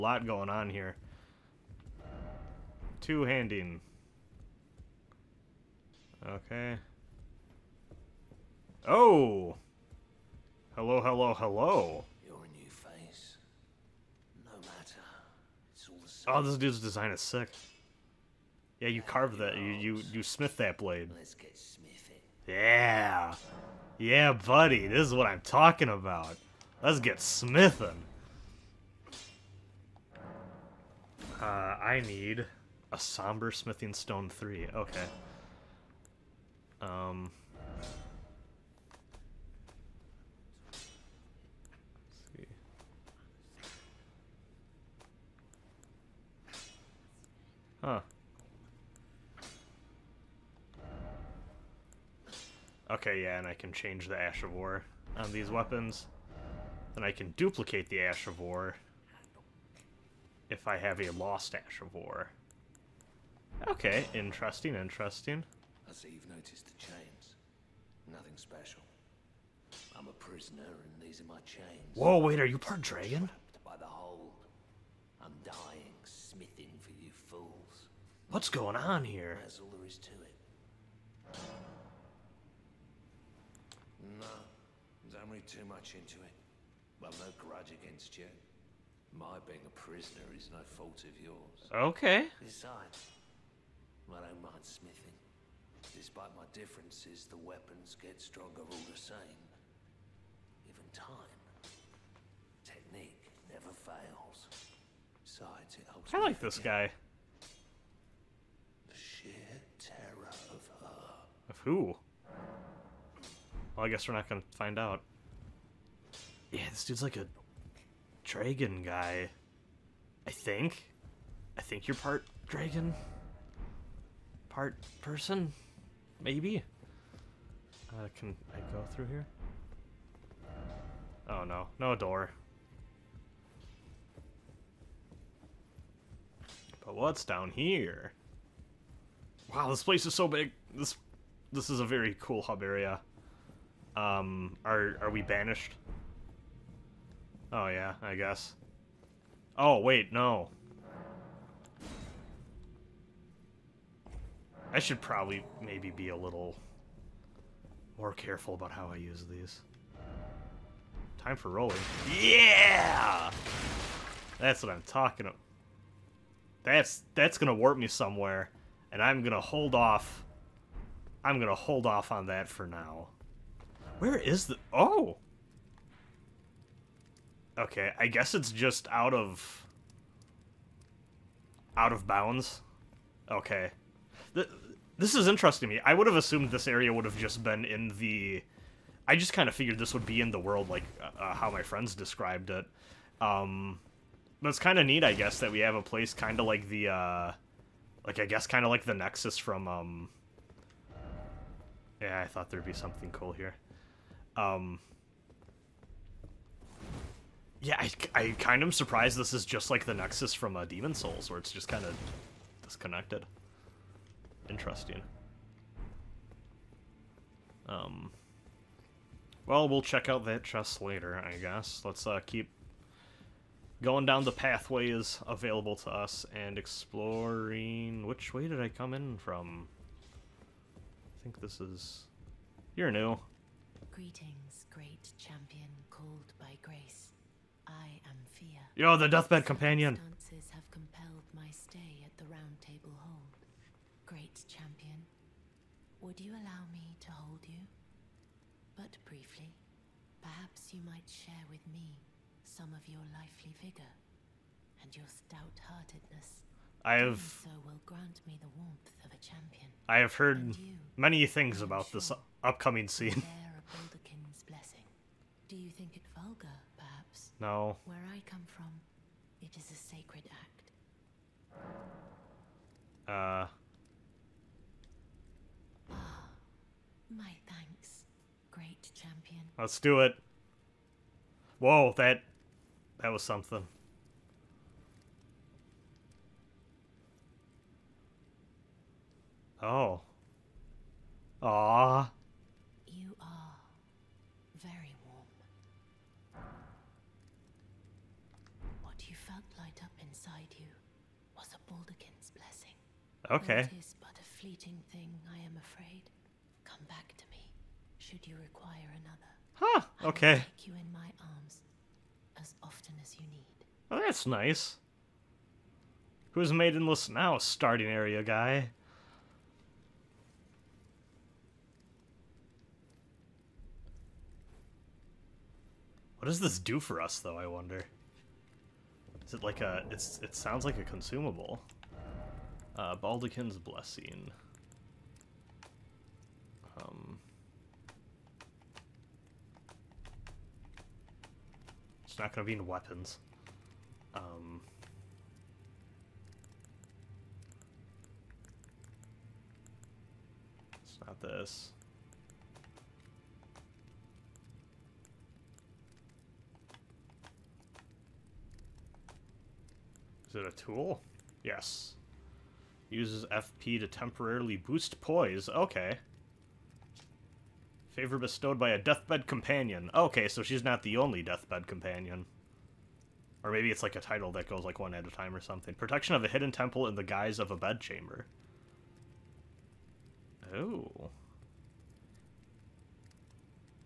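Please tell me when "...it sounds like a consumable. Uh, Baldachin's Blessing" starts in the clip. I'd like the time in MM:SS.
05:30.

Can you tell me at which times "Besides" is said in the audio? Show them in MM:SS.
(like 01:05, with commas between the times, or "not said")
01:32, 01:45.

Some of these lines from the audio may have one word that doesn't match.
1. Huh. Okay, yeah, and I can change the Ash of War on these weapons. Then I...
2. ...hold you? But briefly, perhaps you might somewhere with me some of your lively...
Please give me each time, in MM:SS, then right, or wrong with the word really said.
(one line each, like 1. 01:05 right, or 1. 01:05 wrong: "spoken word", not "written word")
1. 00:47 right
2. 04:07 wrong: "share", not "somewhere".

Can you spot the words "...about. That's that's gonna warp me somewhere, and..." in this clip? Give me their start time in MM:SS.
02:45.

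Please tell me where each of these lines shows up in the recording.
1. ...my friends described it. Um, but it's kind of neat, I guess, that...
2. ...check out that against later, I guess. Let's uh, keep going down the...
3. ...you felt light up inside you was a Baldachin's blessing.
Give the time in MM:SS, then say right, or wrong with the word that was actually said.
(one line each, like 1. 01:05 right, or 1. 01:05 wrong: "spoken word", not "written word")
1. 03:11 right
2. 03:39 wrong: "chest", not "against"
3. 04:59 right.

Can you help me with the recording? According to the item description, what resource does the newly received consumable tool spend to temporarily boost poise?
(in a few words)
FP.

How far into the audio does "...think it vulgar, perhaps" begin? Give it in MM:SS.
04:25.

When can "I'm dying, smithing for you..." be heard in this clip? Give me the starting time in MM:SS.
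01:15.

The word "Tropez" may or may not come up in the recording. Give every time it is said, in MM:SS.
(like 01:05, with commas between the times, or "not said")
not said.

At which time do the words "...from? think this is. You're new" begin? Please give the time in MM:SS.
03:49.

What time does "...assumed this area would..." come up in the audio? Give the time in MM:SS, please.
03:06.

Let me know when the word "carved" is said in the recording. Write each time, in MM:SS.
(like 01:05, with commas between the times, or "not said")
00:19.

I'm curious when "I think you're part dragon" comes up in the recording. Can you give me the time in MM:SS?
02:01.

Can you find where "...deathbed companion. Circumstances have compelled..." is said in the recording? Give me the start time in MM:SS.
03:59.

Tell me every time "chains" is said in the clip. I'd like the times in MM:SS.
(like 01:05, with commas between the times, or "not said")
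01:06, 01:11.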